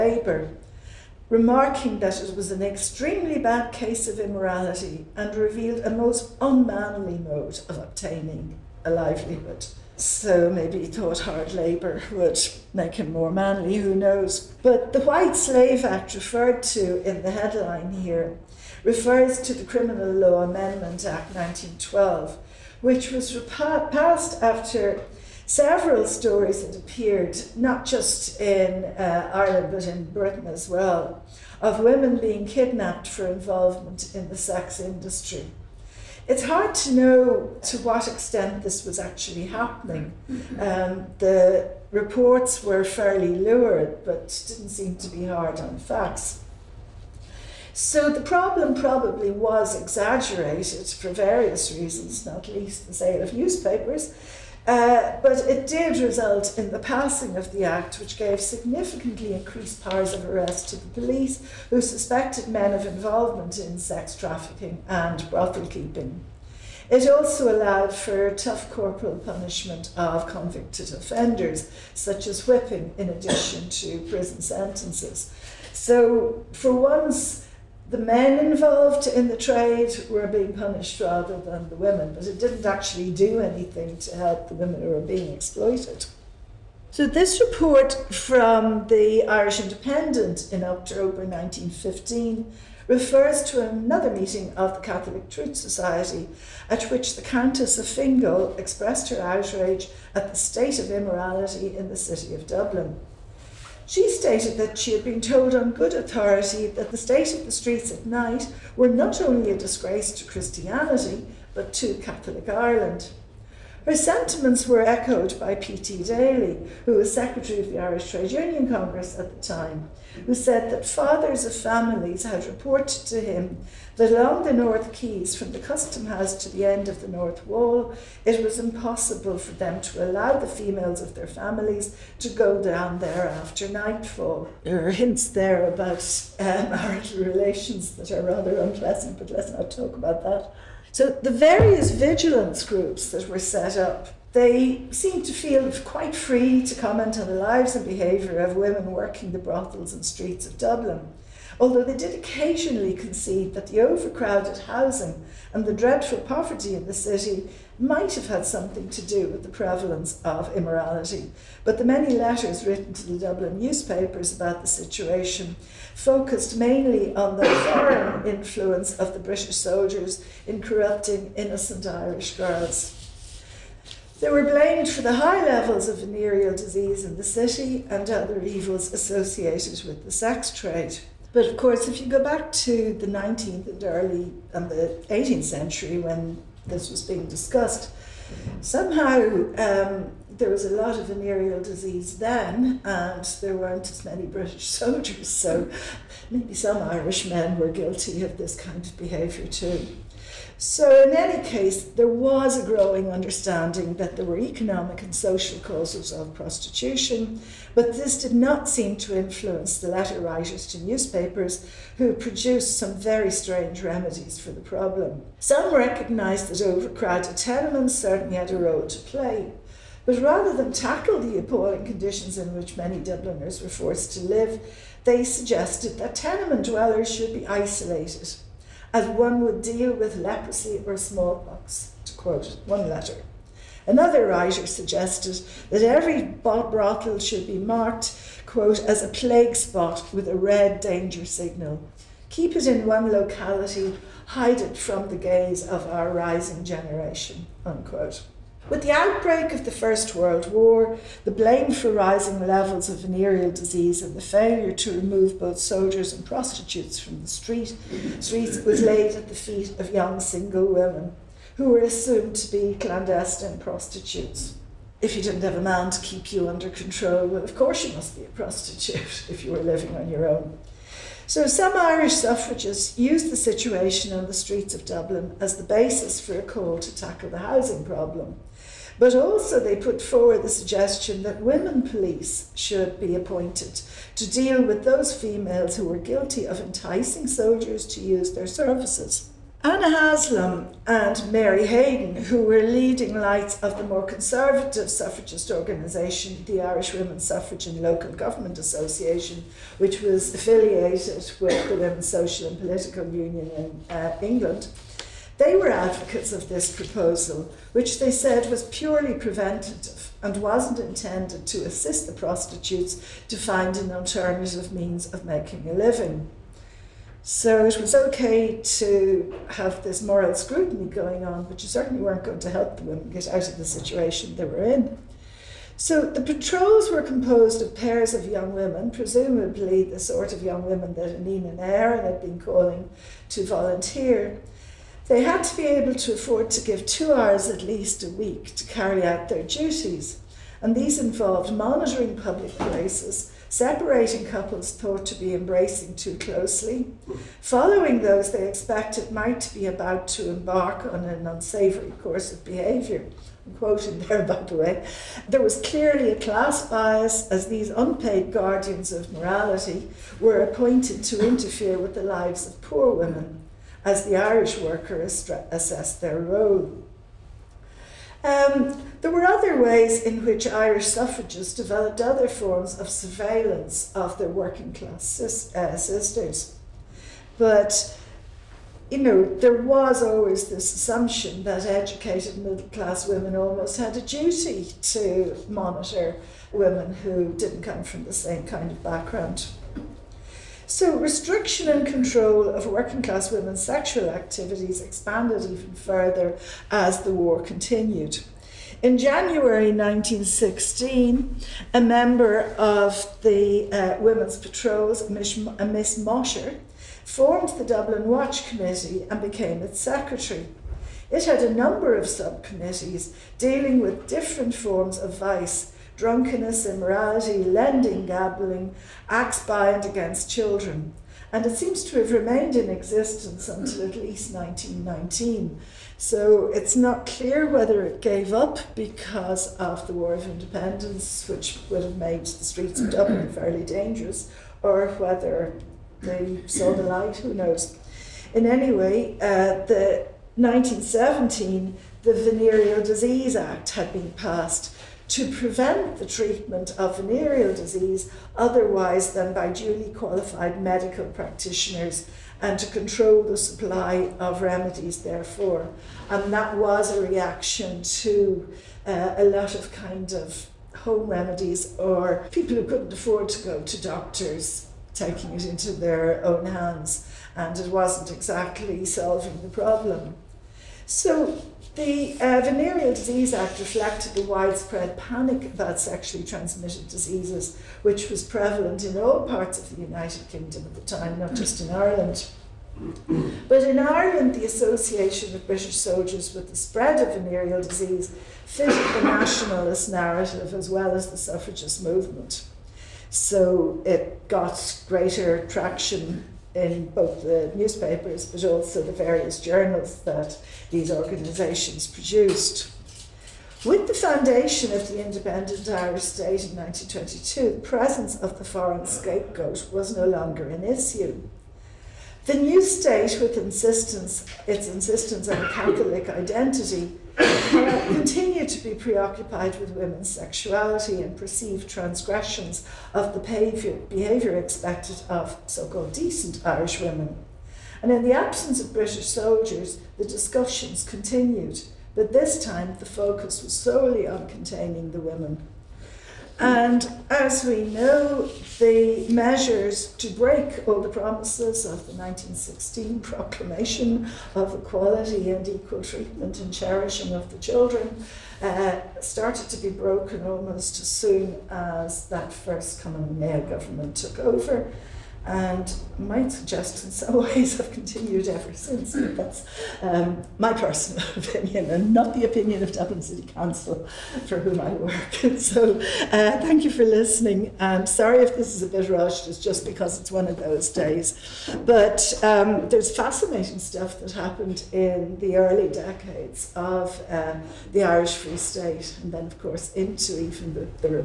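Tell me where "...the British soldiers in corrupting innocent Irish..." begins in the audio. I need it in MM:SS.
02:49.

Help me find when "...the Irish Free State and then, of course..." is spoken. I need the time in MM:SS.
09:37.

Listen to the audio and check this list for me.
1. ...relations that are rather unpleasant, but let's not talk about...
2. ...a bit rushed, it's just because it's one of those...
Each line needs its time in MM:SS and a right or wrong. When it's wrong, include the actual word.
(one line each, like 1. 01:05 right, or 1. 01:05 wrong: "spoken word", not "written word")
1. 02:17 right
2. 09:28 right.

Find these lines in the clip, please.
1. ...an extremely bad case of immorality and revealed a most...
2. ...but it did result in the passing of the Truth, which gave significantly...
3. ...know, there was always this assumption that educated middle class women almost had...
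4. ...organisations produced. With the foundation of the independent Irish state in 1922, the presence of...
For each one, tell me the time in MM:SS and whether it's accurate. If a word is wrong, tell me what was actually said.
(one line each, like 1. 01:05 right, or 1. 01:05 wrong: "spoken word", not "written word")
1. 00:02 right
2. 00:55 wrong: "Act", not "Truth"
3. 06:18 right
4. 08:20 right.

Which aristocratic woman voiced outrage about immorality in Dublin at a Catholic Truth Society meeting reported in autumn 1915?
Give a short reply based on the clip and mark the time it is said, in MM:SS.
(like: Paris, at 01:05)
Countess of Fingal, at 01:37.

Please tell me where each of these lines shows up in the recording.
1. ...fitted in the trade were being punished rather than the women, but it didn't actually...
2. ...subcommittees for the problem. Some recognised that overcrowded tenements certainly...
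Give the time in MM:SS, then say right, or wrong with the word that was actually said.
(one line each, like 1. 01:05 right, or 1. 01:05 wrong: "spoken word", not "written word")
1. 01:18 wrong: "involved", not "fitted"
2. 03:33 wrong: "remedies", not "subcommittees".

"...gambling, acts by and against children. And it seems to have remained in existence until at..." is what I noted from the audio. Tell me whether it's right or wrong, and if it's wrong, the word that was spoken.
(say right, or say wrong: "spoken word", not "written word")
right.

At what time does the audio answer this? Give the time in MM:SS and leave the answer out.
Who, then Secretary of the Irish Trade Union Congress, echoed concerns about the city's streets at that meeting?
01:55.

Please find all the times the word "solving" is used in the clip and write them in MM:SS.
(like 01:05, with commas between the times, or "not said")
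07:48.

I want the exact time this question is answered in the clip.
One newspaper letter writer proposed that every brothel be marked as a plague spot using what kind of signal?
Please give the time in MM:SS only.
04:00.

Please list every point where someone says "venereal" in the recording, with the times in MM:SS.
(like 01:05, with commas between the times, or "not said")
02:55, 03:11, 04:12, 07:22, 07:26, 07:52, 08:07.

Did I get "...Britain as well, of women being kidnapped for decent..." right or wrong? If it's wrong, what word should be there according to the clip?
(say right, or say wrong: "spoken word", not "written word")
wrong: "involvement", not "decent".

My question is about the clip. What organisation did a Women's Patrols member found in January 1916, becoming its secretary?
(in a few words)
Dublin Watch Committee.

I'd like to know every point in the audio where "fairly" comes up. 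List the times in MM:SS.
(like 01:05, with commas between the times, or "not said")
00:42, 07:13.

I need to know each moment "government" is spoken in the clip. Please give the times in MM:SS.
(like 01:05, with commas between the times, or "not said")
04:58, 09:13.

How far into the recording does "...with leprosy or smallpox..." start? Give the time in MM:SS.
03:49.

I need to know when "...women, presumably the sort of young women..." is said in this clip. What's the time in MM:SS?
05:28.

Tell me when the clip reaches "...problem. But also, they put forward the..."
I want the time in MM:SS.
04:37.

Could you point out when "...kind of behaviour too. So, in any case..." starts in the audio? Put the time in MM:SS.
03:18.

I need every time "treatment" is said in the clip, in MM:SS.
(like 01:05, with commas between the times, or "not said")
07:26, 09:05.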